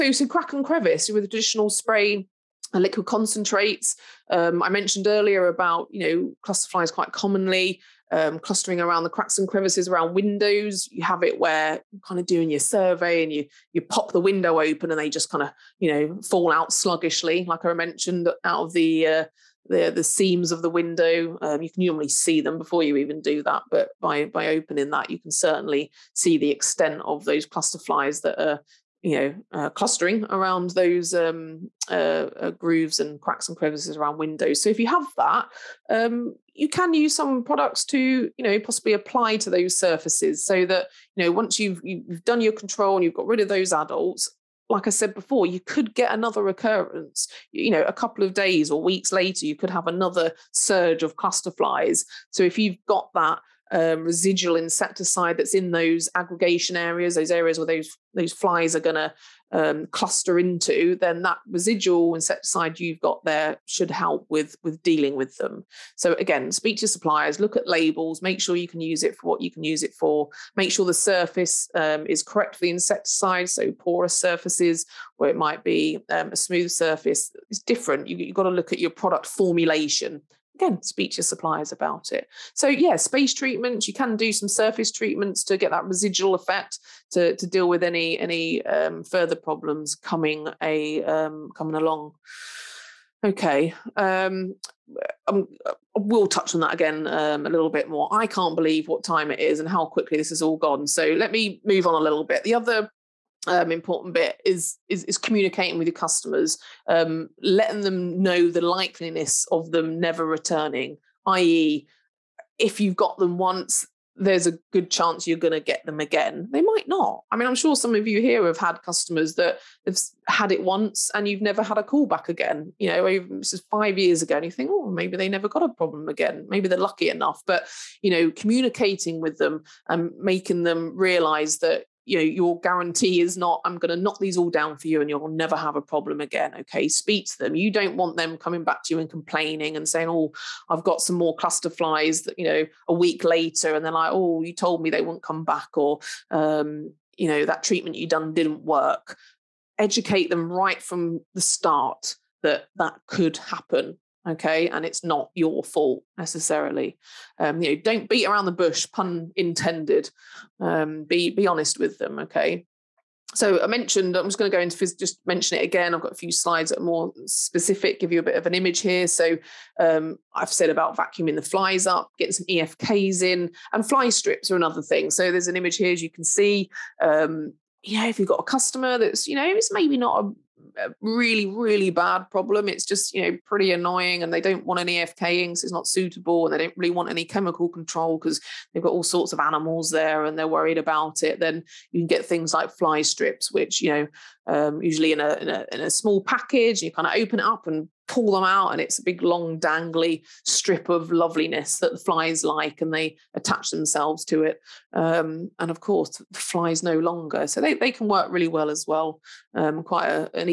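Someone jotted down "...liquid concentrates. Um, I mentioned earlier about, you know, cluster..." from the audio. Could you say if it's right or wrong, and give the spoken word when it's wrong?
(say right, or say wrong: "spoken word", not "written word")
right.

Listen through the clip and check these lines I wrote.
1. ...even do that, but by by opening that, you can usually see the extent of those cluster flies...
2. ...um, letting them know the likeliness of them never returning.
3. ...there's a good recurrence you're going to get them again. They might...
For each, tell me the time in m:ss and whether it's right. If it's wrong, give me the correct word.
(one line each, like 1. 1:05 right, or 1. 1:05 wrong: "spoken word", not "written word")
1. 0:22 wrong: "certainly", not "usually"
2. 1:46 right
3. 1:54 wrong: "chance", not "recurrence".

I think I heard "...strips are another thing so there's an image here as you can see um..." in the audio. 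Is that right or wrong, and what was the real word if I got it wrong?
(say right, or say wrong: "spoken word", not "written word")
right.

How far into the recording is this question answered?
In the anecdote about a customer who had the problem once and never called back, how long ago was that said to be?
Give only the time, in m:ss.
2:03.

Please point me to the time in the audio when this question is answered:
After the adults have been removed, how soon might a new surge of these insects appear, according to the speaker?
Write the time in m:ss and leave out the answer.
0:47.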